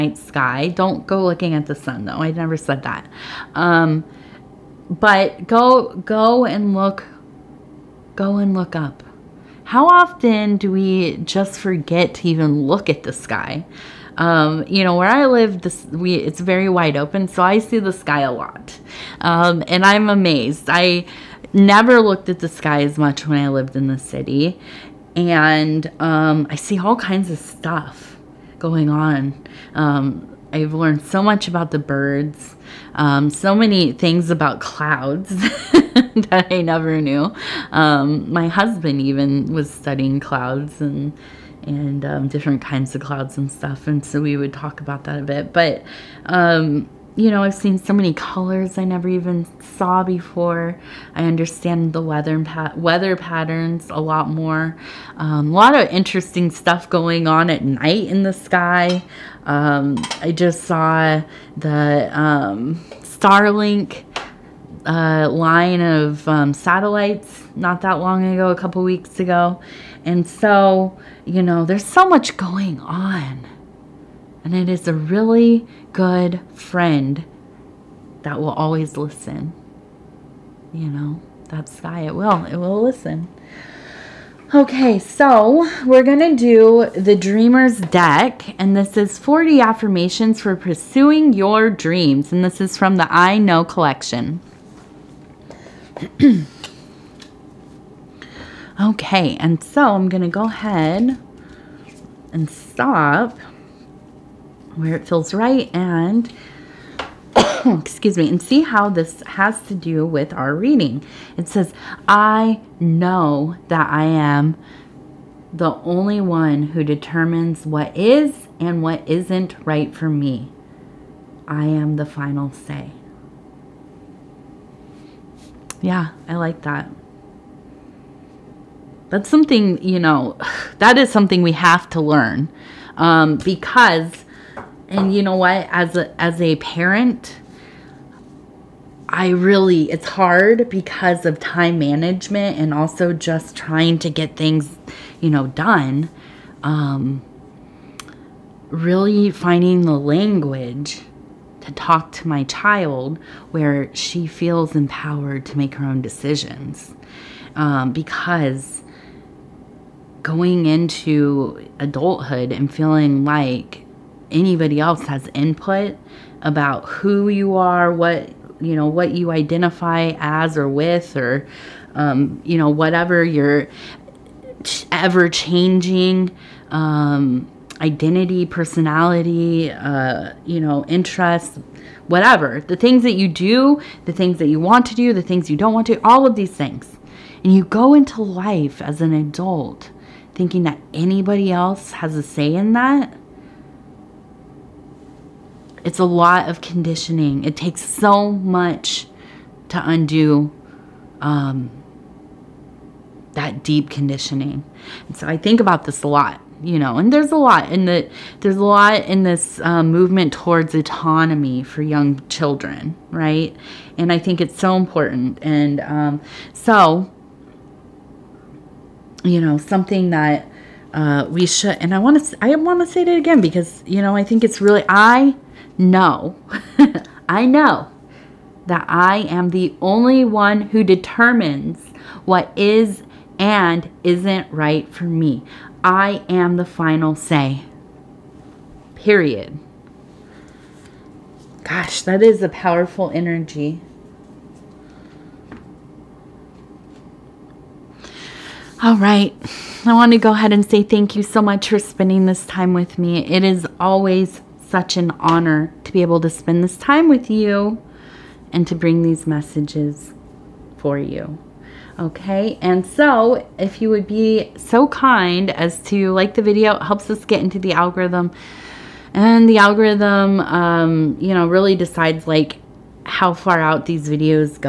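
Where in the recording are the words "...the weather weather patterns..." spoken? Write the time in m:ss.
0:51.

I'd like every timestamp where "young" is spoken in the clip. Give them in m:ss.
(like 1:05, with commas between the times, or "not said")
3:31.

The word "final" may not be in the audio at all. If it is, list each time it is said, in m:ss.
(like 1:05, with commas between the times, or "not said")
2:02, 3:56.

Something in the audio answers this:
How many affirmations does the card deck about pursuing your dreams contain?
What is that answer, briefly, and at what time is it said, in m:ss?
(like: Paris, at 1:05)
40, at 1:29.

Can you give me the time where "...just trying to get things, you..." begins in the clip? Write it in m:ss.
2:23.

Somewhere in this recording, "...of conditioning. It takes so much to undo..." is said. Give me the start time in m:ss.
3:16.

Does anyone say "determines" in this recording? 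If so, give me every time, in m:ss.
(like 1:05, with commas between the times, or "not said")
1:56, 3:50.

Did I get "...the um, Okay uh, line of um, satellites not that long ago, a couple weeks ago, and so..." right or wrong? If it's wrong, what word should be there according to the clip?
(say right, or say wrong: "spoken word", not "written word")
wrong: "Starlink", not "Okay".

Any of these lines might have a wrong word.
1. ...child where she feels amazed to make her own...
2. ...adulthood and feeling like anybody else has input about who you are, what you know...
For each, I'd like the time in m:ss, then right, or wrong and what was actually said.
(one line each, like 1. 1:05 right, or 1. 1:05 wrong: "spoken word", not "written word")
1. 2:32 wrong: "empowered", not "amazed"
2. 2:41 right.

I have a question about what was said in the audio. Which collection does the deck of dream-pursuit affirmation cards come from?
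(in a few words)
I Know collection.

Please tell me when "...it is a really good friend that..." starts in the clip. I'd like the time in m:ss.
1:14.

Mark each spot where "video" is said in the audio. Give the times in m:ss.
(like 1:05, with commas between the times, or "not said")
4:26, 4:34.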